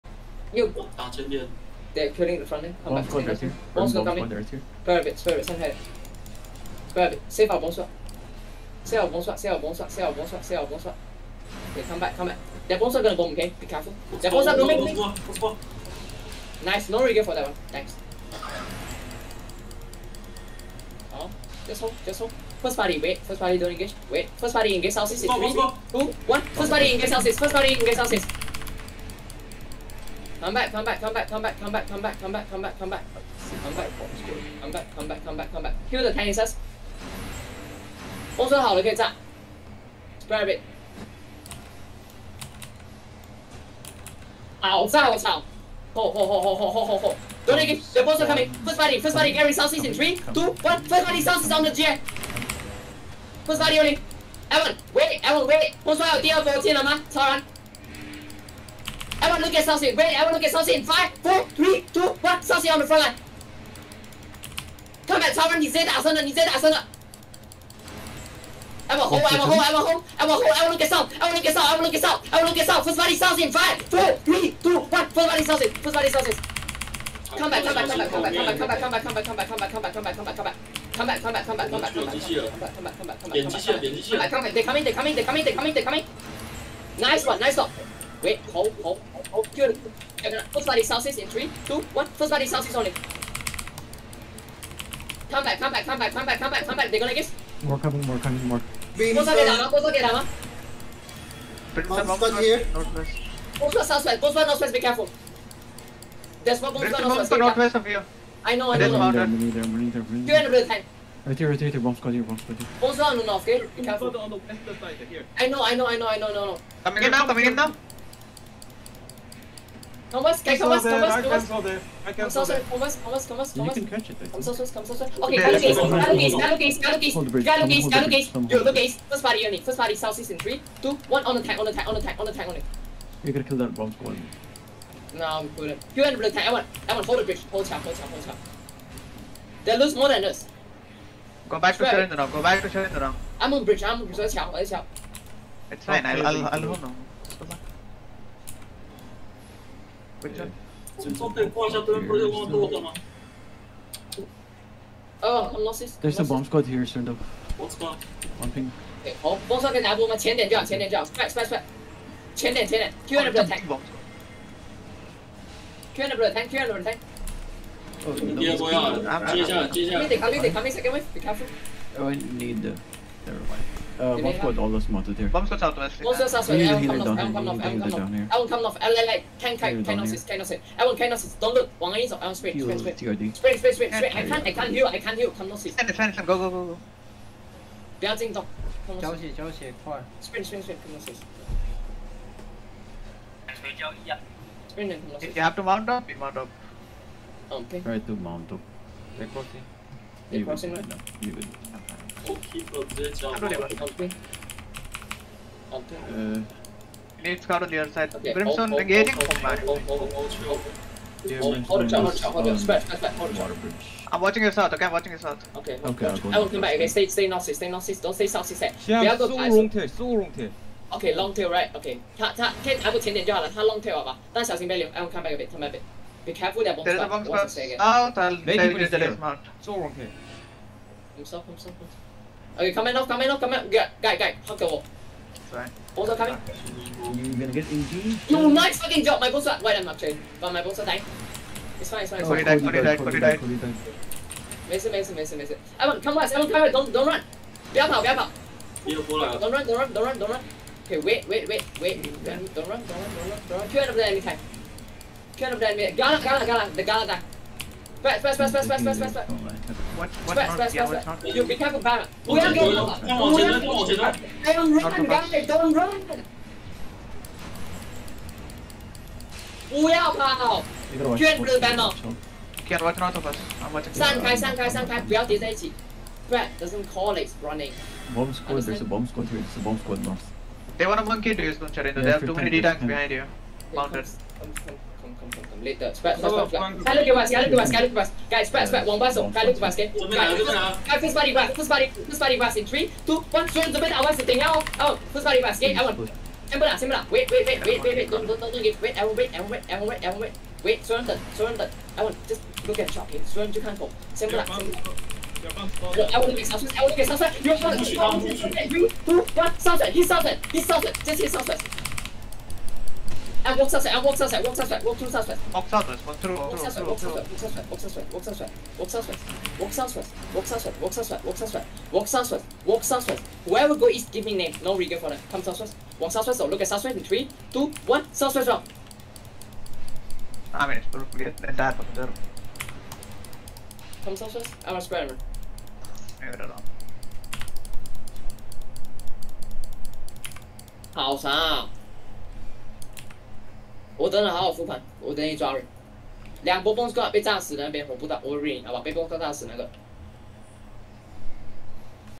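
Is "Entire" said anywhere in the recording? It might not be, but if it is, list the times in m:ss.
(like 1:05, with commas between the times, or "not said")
5:31.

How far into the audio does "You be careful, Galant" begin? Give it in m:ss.
4:21.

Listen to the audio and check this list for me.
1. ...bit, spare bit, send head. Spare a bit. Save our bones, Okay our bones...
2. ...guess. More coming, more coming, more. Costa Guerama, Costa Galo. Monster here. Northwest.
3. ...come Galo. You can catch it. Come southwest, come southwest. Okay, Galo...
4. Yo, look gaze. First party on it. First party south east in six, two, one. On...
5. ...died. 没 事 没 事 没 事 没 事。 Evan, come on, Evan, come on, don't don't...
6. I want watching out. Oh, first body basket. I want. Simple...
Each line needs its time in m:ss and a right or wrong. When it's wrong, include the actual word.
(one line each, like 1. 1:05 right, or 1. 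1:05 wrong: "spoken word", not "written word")
1. 0:05 wrong: "Save", not "Okay"
2. 1:37 wrong: "Guerama", not "Galo"
3. 2:02 wrong: "Thomas", not "Galo"
4. 2:08 wrong: "three", not "six"
5. 4:03 right
6. 4:53 wrong: "sitting", not "watching".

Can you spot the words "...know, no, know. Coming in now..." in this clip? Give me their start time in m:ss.
1:56.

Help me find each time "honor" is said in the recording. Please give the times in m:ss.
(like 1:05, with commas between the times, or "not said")
not said.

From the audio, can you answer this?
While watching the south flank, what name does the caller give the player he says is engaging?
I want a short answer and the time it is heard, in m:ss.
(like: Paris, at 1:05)
Brimstone, at 3:28.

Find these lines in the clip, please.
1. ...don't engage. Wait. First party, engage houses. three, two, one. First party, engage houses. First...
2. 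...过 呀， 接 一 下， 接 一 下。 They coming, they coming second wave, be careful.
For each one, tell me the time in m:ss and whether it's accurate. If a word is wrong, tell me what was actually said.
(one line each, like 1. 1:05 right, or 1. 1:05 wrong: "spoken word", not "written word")
1. 0:23 right
2. 2:48 right.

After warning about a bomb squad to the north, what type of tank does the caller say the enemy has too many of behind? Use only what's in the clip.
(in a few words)
D-tanks.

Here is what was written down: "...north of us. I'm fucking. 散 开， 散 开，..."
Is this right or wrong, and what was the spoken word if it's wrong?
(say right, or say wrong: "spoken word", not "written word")
wrong: "watching", not "fucking".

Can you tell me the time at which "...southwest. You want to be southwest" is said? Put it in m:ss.
5:07.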